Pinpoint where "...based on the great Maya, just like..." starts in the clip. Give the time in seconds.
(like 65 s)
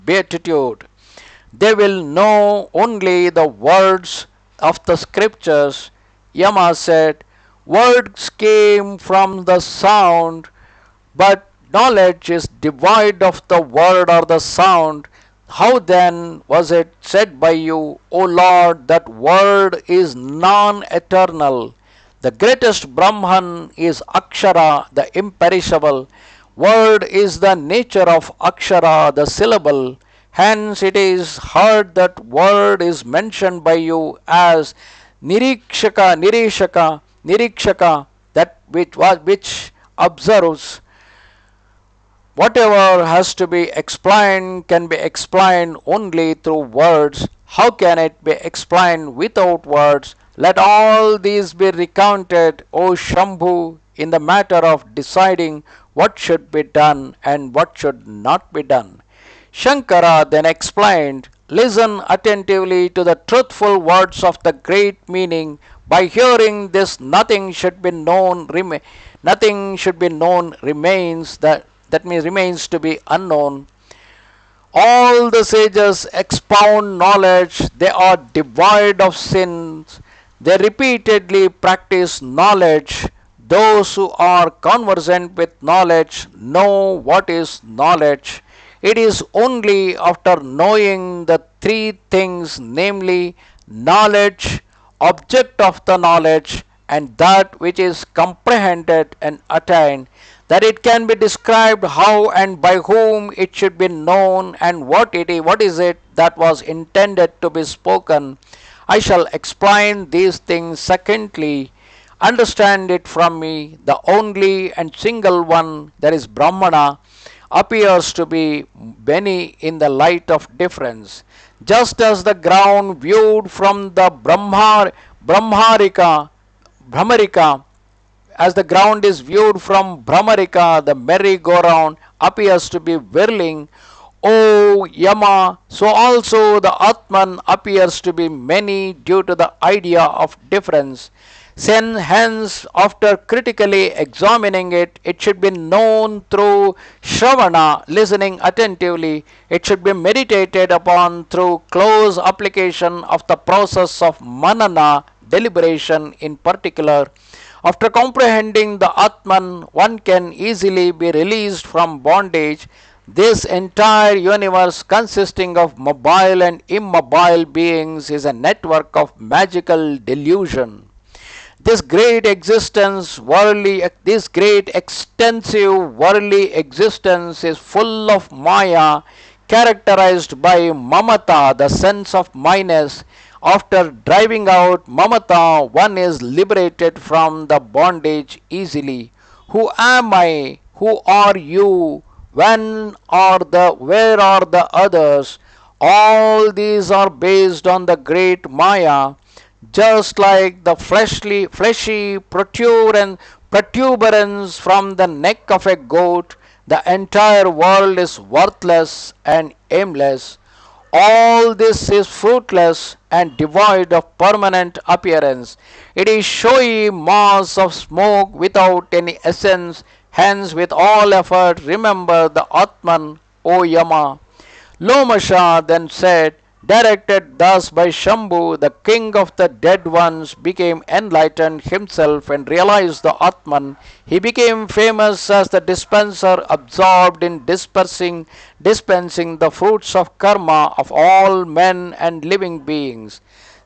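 197 s.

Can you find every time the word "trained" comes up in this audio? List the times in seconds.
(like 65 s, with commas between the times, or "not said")
not said.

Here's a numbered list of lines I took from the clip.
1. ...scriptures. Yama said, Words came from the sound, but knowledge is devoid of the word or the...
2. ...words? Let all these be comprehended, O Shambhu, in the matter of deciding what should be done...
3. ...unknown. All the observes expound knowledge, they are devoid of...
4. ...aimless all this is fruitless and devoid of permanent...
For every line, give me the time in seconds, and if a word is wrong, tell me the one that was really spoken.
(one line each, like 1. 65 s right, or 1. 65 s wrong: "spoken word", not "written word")
1. 4 s right
2. 49 s wrong: "recounted", not "comprehended"
3. 73 s wrong: "sages", not "observes"
4. 209 s right.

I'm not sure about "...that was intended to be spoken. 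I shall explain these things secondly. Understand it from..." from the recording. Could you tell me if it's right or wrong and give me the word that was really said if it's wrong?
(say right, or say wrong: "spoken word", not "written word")
right.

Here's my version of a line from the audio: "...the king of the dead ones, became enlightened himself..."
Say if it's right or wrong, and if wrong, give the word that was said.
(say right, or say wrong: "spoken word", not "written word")
right.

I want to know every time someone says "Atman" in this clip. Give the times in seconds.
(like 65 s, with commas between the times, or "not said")
136 s, 158 s, 222 s, 233 s.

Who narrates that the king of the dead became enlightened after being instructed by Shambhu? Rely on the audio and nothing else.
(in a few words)
Lomasha.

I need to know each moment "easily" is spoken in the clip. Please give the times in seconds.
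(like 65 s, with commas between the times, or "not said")
160 s, 188 s.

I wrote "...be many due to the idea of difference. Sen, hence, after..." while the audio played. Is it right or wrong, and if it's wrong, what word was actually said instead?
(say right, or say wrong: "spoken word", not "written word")
right.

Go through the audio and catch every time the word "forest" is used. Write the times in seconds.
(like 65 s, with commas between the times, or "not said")
not said.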